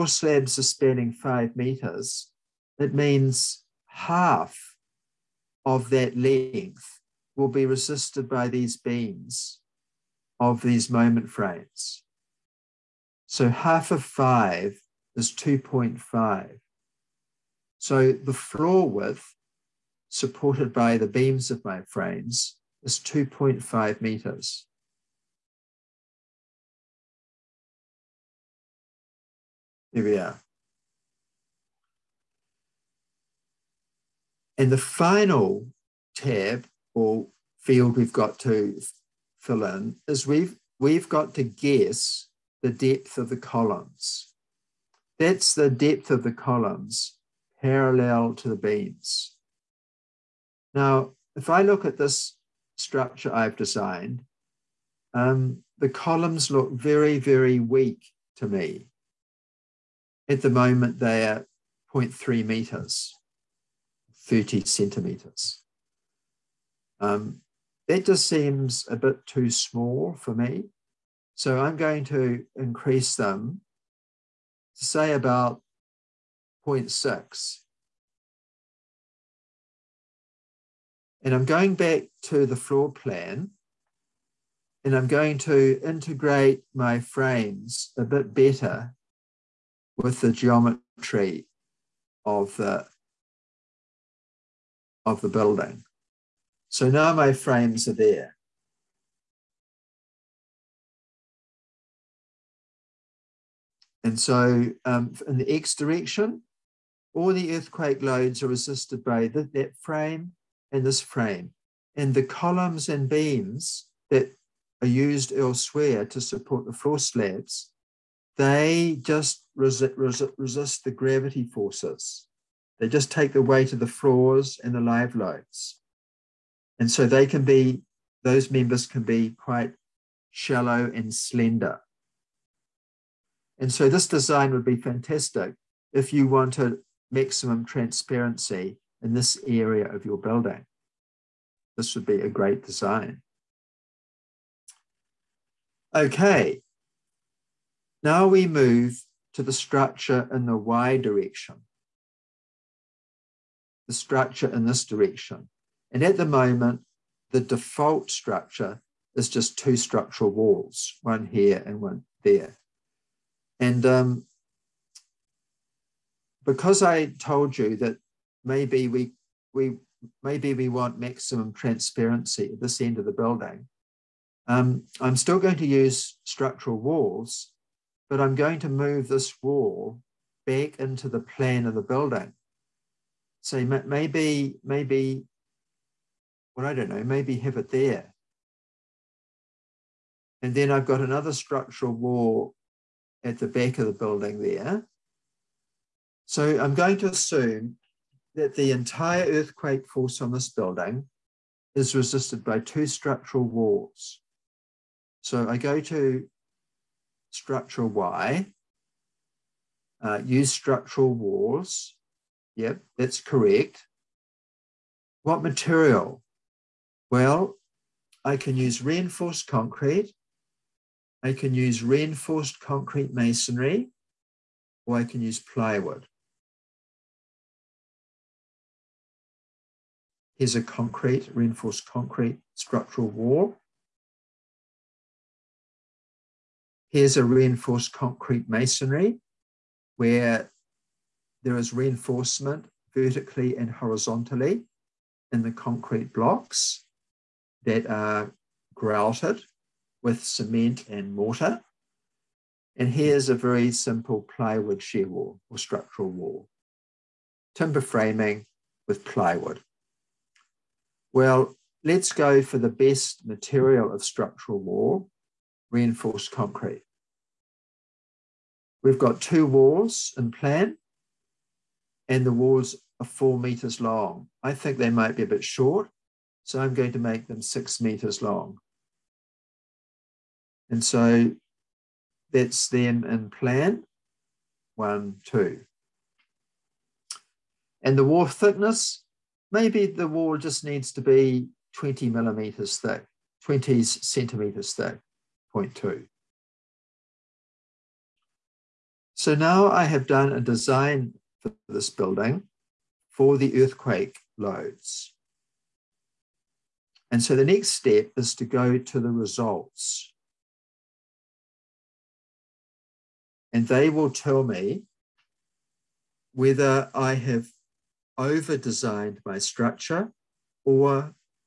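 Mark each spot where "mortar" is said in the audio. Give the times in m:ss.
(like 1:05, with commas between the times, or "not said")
4:11.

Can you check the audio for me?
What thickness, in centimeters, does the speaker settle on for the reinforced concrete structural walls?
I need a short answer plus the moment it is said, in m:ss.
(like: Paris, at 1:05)
20, at 4:53.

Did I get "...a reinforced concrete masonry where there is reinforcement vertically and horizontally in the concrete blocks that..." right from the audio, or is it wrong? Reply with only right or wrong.
right.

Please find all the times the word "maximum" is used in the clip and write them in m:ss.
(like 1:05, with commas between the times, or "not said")
2:17, 2:50.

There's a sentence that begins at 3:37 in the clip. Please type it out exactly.
Well, I can use reinforced concrete I can use reinforced concrete masonry or I can use plywood.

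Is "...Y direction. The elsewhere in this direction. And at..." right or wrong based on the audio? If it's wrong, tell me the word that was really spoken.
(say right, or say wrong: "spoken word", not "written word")
wrong: "structure", not "elsewhere".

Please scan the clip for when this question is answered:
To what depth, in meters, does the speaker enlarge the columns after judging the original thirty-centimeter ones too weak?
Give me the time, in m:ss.
1:16.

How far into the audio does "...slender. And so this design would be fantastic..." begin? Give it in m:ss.
2:11.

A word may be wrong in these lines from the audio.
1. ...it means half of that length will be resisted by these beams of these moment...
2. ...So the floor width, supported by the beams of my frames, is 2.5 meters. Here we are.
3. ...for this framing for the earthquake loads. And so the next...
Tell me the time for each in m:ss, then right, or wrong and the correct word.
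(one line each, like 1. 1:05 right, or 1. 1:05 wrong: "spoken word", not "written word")
1. 0:02 right
2. 0:17 right
3. 5:01 wrong: "building", not "framing".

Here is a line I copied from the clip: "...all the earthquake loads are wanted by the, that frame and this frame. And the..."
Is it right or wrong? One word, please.
wrong.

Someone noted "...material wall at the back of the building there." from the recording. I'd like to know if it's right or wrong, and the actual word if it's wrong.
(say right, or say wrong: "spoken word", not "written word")
wrong: "structural", not "material".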